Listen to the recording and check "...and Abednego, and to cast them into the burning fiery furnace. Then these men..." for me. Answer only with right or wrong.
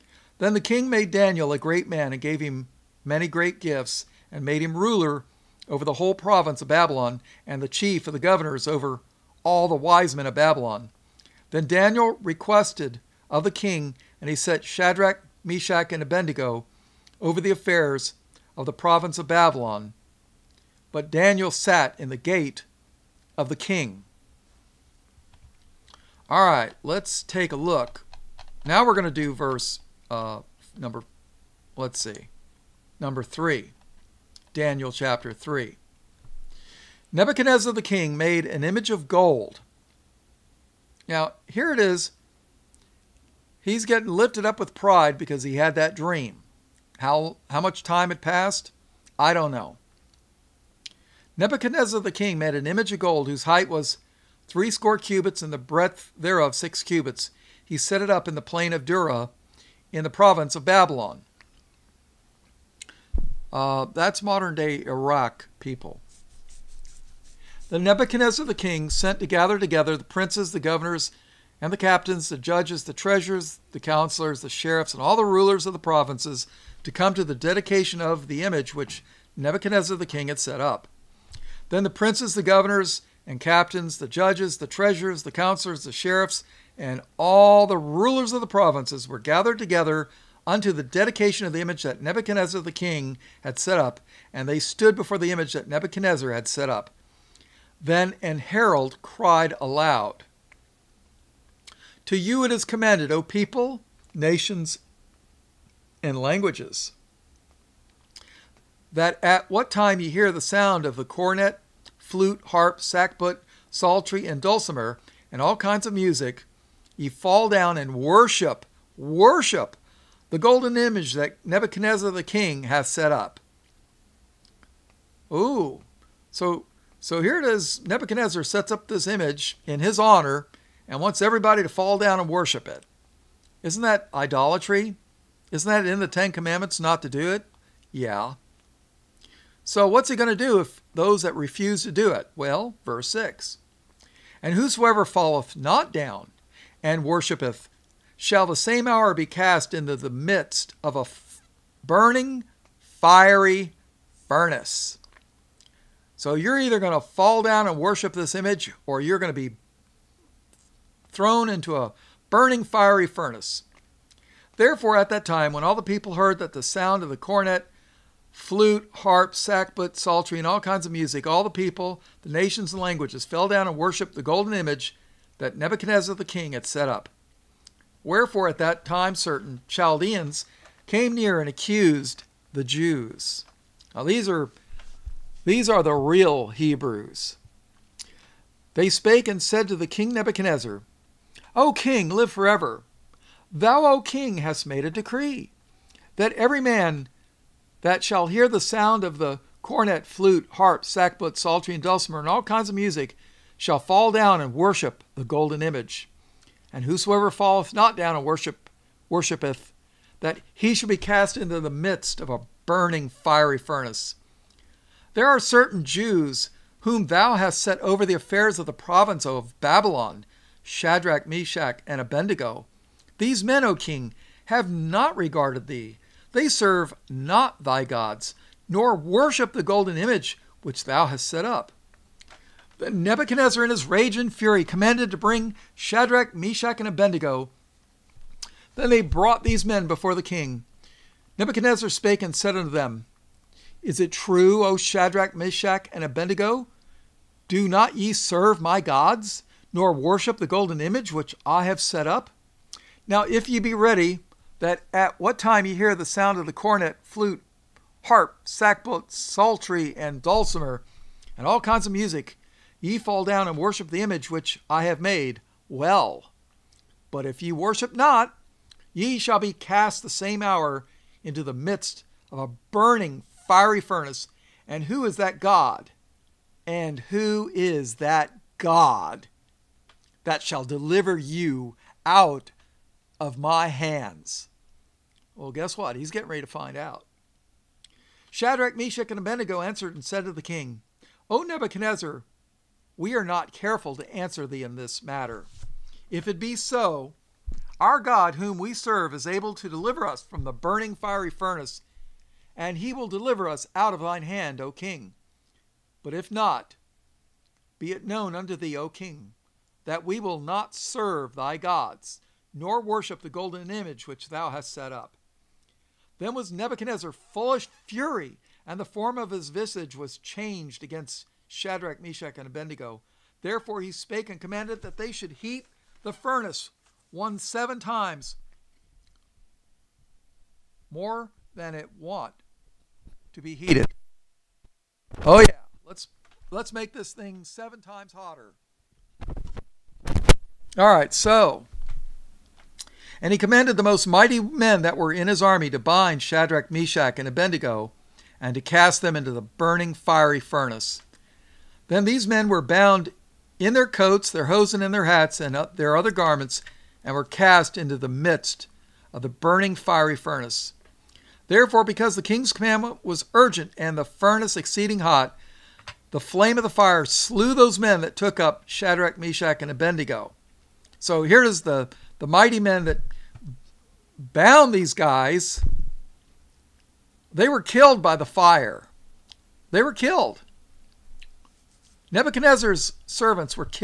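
right.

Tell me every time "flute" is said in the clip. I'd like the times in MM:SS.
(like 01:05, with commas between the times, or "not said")
01:52, 02:48, 03:20, 04:17.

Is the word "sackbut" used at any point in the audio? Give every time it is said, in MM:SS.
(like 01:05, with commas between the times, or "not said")
01:52, 02:49, 03:20, 04:18.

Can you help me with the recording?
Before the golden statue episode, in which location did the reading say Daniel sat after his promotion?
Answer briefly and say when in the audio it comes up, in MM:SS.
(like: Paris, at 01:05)
the gate of the king, at 00:22.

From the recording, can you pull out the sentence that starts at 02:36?
So you're either going to fall down and worship this image or you're going to be thrown into a burning, fiery furnace.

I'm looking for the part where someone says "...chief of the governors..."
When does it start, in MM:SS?
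00:07.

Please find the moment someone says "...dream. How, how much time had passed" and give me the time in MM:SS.
00:45.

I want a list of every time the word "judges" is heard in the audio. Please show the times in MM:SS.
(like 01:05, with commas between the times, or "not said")
01:12, 01:24.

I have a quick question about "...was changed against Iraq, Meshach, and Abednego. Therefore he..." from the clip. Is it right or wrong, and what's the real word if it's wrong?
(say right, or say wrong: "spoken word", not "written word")
wrong: "Shadrach", not "Iraq".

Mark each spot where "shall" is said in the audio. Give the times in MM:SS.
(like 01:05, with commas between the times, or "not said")
02:28, 03:18, 03:23, 03:30, 04:29, 04:40.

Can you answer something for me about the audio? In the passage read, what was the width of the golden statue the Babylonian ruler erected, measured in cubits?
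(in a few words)
6 cubits.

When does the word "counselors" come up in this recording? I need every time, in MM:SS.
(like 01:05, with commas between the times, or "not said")
01:13, 01:25.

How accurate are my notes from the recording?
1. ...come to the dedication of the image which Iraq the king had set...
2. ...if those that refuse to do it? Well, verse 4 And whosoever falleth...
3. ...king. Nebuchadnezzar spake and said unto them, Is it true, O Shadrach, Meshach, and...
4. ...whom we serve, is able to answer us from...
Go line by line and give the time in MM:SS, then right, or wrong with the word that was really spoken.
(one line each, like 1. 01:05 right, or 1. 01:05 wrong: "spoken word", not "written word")
1. 01:16 wrong: "Nebuchadnezzar", not "Iraq"
2. 02:20 wrong: "6", not "4"
3. 04:00 right
4. 04:58 wrong: "deliver", not "answer".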